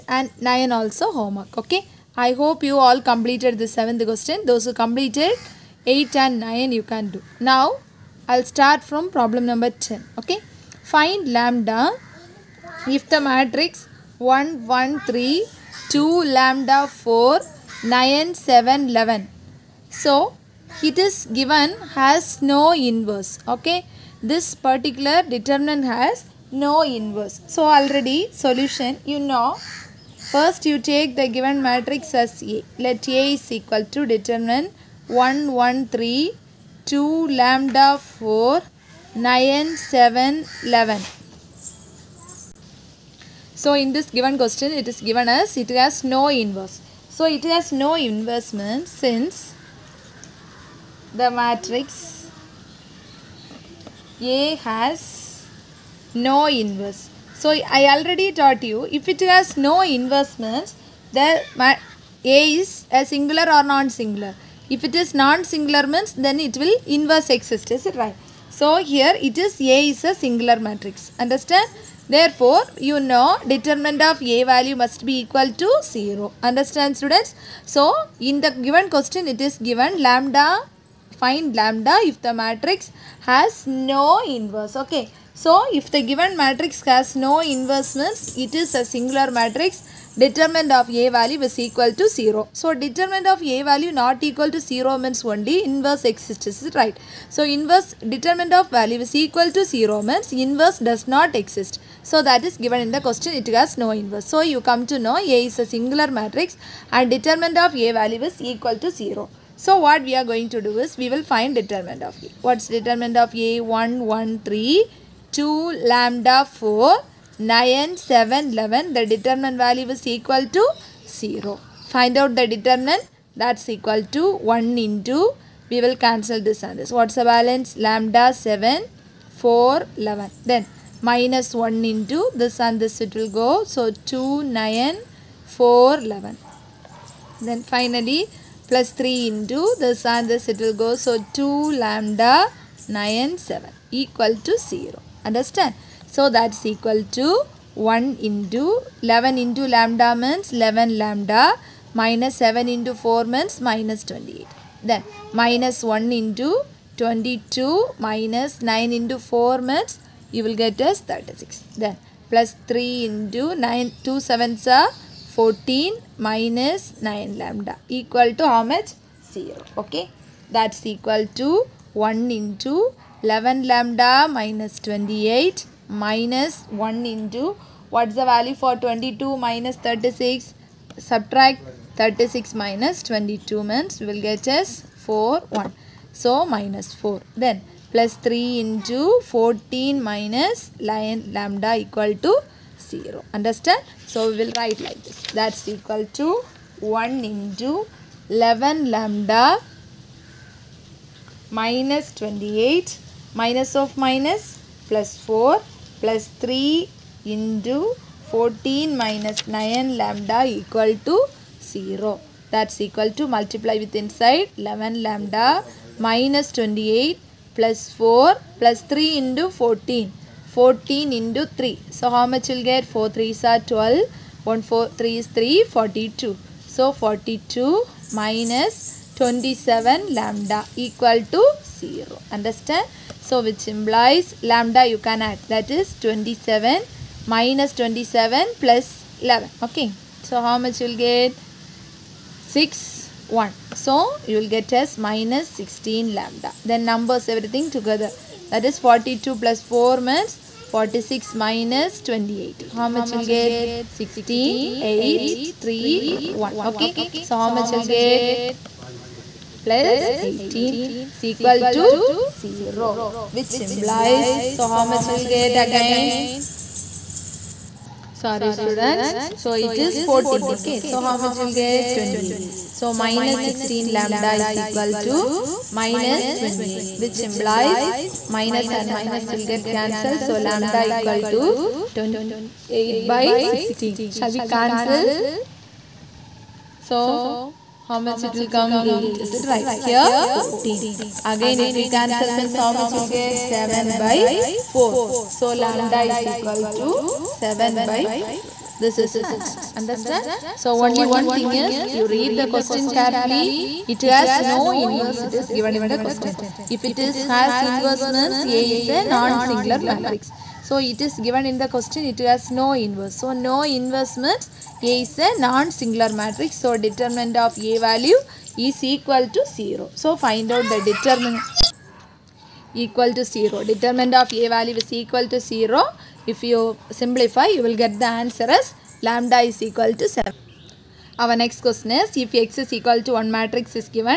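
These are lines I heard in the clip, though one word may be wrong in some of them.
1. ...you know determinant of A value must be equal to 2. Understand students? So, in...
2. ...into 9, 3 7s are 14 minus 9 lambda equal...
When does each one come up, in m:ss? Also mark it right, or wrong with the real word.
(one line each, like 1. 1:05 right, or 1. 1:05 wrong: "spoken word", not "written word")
1. 1:12 wrong: "0", not "2"
2. 2:43 wrong: "2", not "3".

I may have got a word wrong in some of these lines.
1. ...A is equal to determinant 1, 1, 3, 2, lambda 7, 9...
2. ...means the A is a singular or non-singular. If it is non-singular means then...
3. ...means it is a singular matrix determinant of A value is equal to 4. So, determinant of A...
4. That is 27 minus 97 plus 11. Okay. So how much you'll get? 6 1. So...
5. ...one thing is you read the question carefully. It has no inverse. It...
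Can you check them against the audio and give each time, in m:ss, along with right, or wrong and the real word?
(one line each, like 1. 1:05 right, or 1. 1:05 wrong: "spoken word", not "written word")
1. 0:33 wrong: "4", not "7"
2. 1:00 right
3. 1:27 wrong: "0", not "4"
4. 3:55 wrong: "27", not "97"
5. 5:01 right.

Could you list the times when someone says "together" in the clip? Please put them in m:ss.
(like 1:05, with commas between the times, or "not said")
4:07.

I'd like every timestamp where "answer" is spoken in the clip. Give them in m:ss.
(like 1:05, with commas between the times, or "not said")
4:59, 5:28.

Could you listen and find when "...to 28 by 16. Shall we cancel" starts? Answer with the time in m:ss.
4:41.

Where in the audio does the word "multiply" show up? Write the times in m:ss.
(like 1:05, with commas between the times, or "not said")
3:33.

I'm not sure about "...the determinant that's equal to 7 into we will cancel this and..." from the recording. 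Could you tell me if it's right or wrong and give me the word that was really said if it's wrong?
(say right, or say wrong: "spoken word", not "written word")
wrong: "1", not "7".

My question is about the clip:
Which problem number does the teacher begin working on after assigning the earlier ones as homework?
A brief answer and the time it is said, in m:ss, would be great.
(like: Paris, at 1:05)
10, at 0:09.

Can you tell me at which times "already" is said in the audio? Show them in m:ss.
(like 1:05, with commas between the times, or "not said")
0:27, 0:57.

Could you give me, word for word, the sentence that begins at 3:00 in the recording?
Subtract 36 minus 22 means we will get as 4 1.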